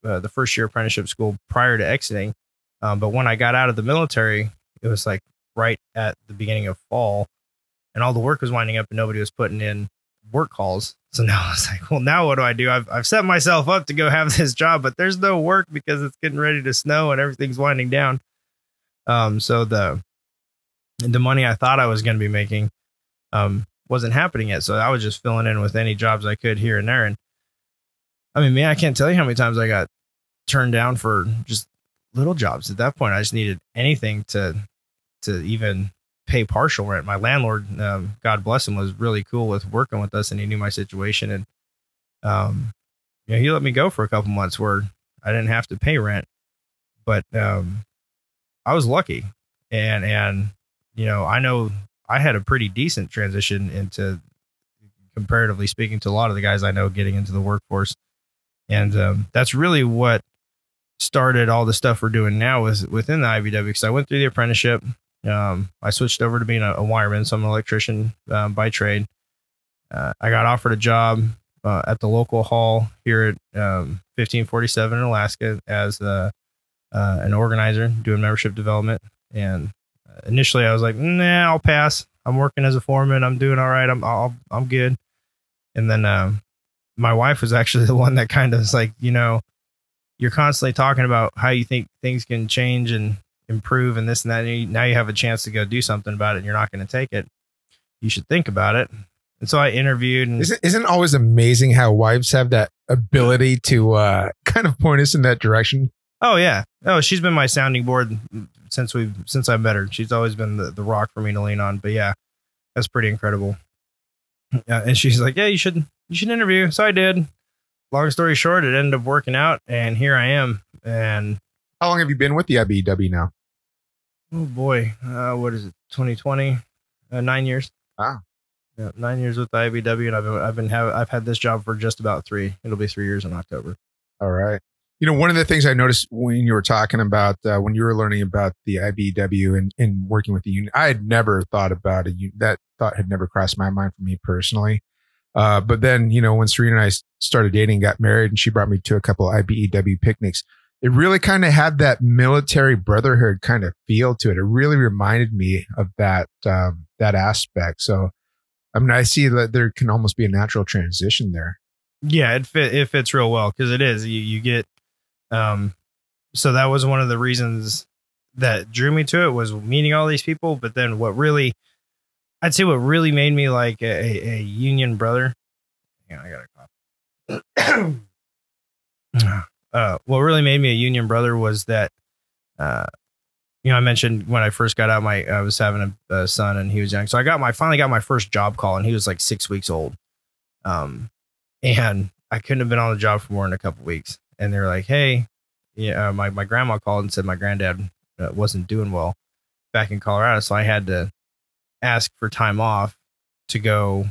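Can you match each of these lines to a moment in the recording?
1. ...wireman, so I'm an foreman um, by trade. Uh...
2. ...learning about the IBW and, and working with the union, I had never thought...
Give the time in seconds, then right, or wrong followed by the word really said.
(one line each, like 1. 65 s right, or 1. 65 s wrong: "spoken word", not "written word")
1. 66 s wrong: "electrician", not "foreman"
2. 137 s right.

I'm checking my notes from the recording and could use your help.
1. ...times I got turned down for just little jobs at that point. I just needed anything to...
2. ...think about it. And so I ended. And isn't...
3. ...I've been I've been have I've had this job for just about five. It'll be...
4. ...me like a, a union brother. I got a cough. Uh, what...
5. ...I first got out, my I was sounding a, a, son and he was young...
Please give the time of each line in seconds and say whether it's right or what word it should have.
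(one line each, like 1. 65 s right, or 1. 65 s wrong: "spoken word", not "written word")
1. 29 s right
2. 98 s wrong: "interviewed", not "ended"
3. 130 s wrong: "three", not "five"
4. 173 s right
5. 184 s wrong: "having", not "sounding".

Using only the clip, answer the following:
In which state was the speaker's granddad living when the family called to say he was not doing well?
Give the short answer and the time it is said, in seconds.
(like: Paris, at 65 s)
Colorado, at 199 s.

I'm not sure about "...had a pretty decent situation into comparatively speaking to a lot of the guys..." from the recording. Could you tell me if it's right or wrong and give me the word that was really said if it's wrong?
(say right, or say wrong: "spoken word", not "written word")
wrong: "transition", not "situation".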